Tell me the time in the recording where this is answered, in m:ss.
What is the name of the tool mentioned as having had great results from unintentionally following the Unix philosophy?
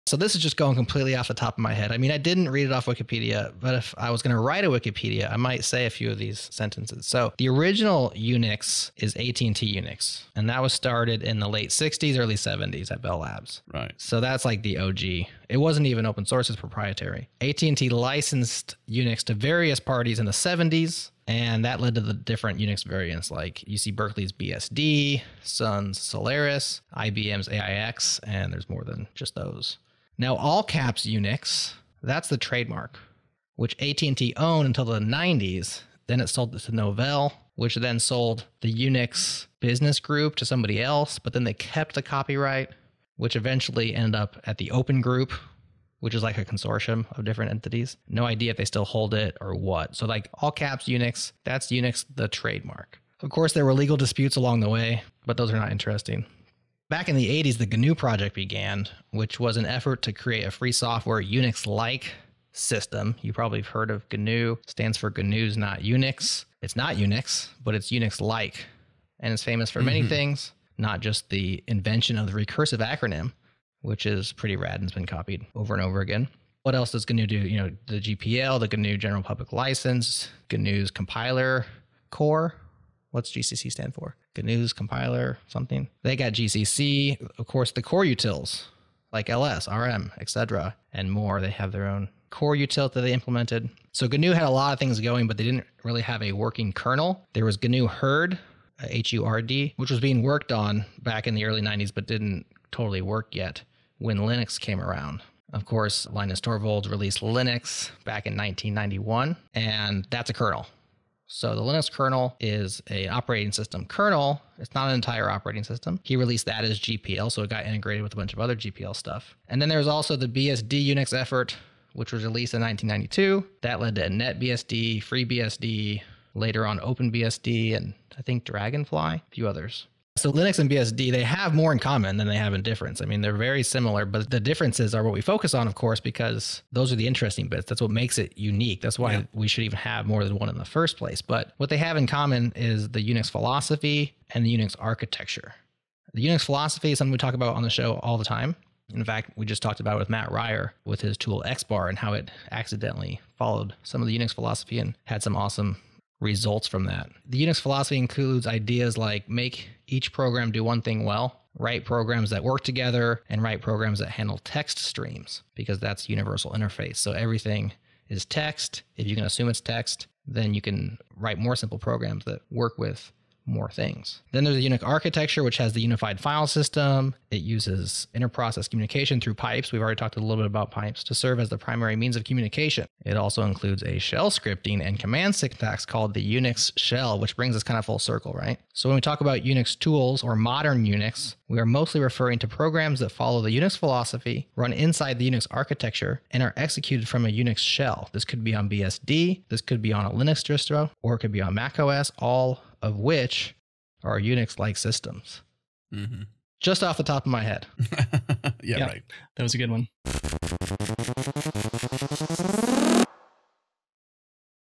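2:31.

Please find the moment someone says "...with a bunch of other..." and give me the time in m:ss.
1:58.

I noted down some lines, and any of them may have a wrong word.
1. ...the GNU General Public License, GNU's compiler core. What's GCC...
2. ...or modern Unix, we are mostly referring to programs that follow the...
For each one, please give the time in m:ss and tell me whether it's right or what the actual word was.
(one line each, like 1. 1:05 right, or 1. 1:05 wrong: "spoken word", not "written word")
1. 1:18 right
2. 3:10 right.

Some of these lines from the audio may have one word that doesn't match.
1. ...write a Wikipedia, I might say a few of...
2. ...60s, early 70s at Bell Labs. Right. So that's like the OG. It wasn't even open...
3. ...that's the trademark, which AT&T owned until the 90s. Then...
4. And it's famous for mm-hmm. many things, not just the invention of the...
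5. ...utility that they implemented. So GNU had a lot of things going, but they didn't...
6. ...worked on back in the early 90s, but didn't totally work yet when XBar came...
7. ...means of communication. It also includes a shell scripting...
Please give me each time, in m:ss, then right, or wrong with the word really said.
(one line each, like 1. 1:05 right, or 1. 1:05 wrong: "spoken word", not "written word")
1. 0:04 right
2. 0:11 right
3. 0:32 right
4. 1:09 right
5. 1:32 right
6. 1:40 wrong: "Linux", not "XBar"
7. 3:01 right.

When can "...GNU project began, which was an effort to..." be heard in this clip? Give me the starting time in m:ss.
0:57.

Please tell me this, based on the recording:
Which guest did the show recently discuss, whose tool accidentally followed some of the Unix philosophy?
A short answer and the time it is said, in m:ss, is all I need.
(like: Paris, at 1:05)
Mat Ryer, at 2:30.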